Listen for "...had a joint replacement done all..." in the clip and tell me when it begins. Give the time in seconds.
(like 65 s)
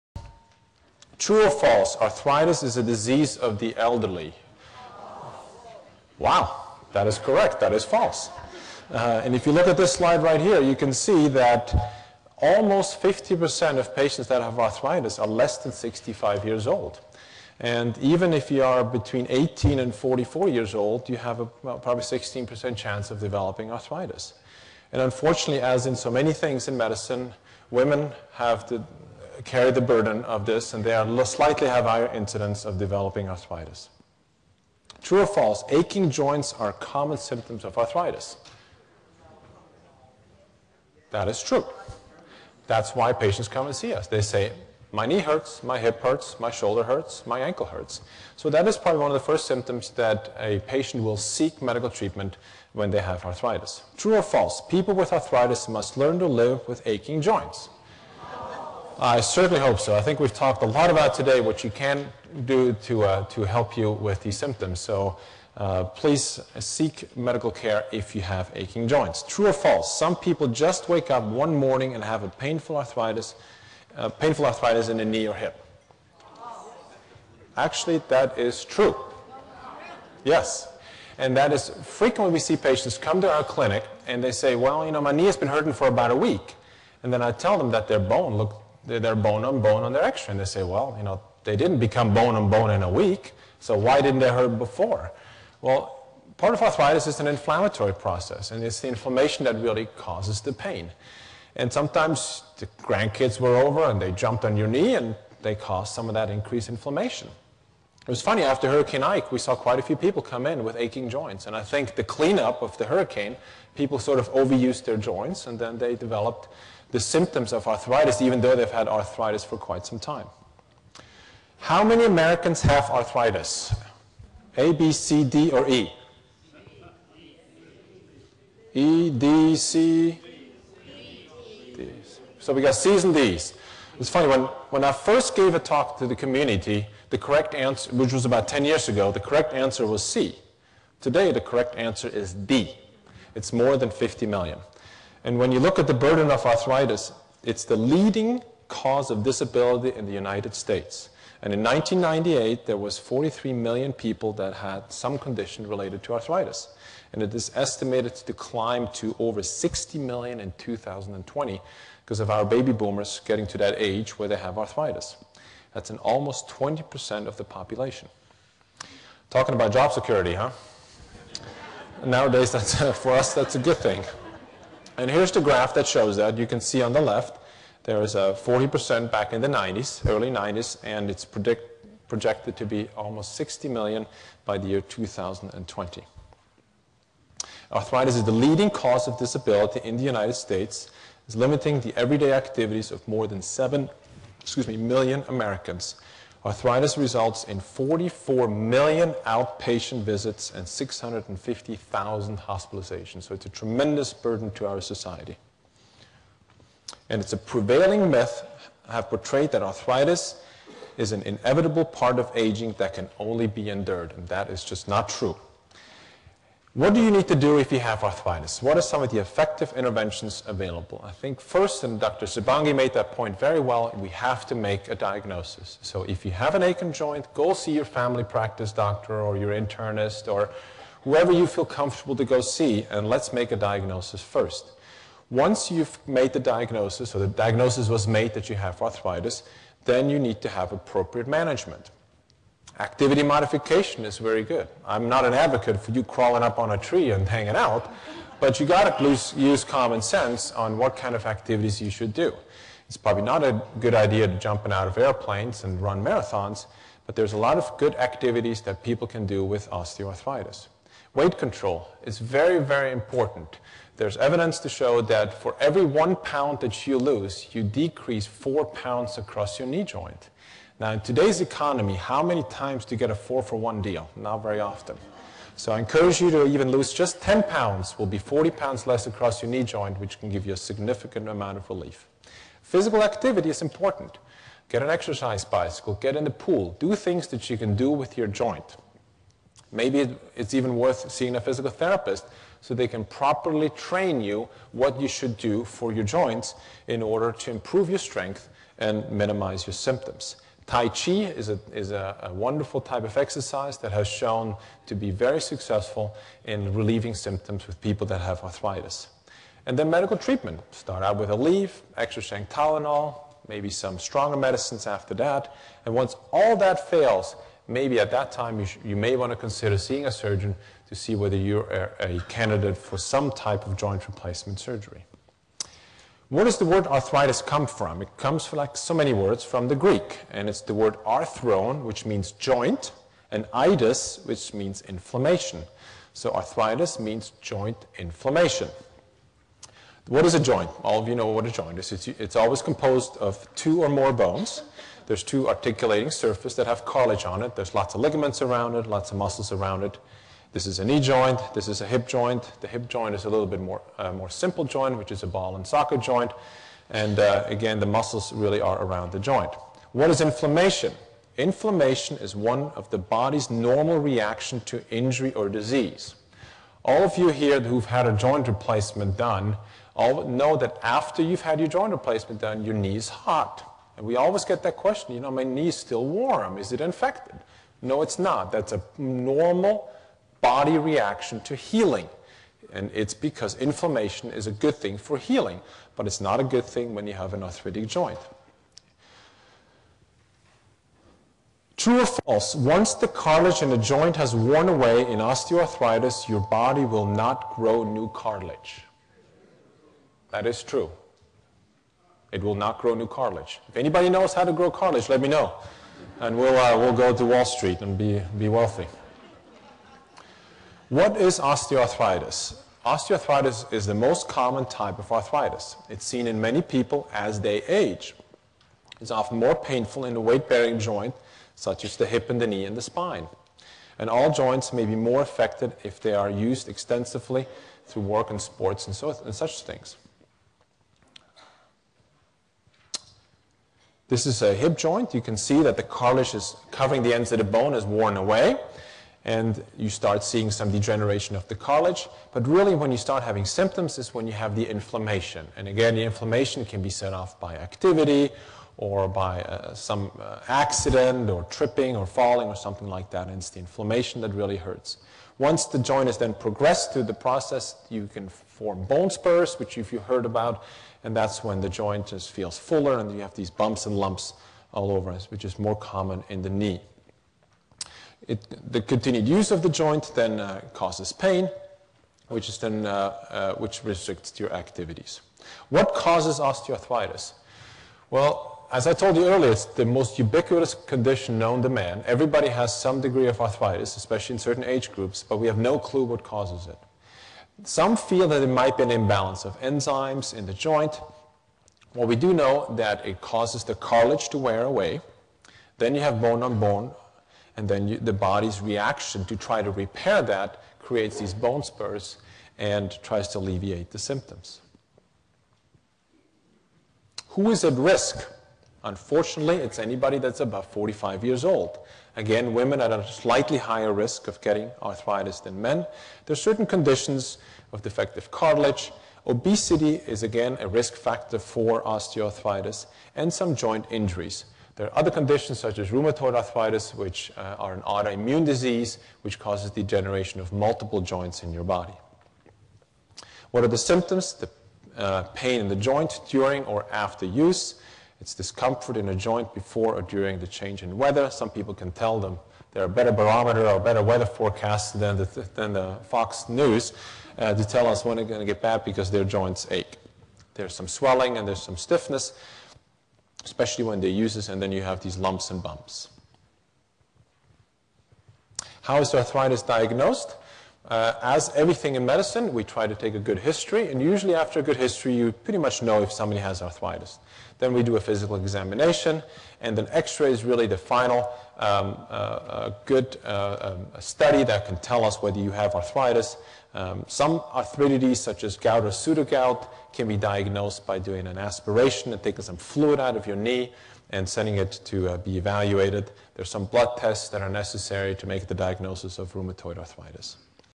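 367 s.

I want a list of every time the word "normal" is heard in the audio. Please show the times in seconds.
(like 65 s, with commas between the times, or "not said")
363 s, 378 s.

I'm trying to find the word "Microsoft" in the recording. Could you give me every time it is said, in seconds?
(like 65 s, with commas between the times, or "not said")
not said.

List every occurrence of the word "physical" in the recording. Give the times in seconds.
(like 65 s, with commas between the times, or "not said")
282 s, 291 s, 568 s.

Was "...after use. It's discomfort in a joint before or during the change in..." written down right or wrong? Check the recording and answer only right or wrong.
right.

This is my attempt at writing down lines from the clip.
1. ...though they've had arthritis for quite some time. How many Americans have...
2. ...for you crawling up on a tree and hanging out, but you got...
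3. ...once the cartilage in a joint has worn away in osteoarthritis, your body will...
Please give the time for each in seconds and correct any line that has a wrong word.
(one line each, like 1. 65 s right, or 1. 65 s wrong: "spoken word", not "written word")
1. 118 s right
2. 245 s right
3. 392 s right.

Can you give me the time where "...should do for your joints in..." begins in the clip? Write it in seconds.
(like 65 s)
295 s.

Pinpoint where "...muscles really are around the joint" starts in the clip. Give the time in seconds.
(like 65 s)
357 s.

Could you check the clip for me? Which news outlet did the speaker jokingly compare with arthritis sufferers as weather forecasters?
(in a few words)
Fox News.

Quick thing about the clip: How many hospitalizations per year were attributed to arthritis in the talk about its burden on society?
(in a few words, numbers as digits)
650,000.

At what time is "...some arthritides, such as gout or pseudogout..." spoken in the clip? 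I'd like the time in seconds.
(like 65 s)
577 s.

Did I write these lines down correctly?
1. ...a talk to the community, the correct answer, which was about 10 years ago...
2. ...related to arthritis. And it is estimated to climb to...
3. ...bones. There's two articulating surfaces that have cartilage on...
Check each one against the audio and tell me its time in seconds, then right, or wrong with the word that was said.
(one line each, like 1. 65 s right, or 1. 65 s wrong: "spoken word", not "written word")
1. 135 s right
2. 155 s right
3. 344 s right.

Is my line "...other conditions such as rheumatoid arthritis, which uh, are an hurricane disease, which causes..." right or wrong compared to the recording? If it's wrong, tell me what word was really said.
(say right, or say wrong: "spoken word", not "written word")
wrong: "autoimmune", not "hurricane".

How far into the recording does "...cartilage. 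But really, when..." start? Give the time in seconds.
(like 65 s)
441 s.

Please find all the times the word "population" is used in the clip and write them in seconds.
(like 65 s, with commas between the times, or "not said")
167 s.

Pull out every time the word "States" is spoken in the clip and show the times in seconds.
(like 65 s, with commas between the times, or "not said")
150 s, 190 s.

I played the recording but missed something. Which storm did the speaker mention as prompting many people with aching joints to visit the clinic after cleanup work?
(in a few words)
Hurricane Ike.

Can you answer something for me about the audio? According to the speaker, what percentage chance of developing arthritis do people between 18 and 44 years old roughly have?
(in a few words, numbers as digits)
16%.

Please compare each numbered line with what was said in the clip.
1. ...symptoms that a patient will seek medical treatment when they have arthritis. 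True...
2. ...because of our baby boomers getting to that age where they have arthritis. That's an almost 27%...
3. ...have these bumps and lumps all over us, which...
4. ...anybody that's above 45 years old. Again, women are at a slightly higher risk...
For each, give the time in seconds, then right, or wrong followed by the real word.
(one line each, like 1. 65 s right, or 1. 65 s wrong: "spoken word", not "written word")
1. 49 s right
2. 162 s wrong: "20", not "27"
3. 463 s right
4. 509 s right.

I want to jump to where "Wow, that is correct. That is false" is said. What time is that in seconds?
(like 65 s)
6 s.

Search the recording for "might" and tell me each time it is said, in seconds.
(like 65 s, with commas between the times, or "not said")
488 s.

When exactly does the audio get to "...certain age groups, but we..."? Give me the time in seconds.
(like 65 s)
484 s.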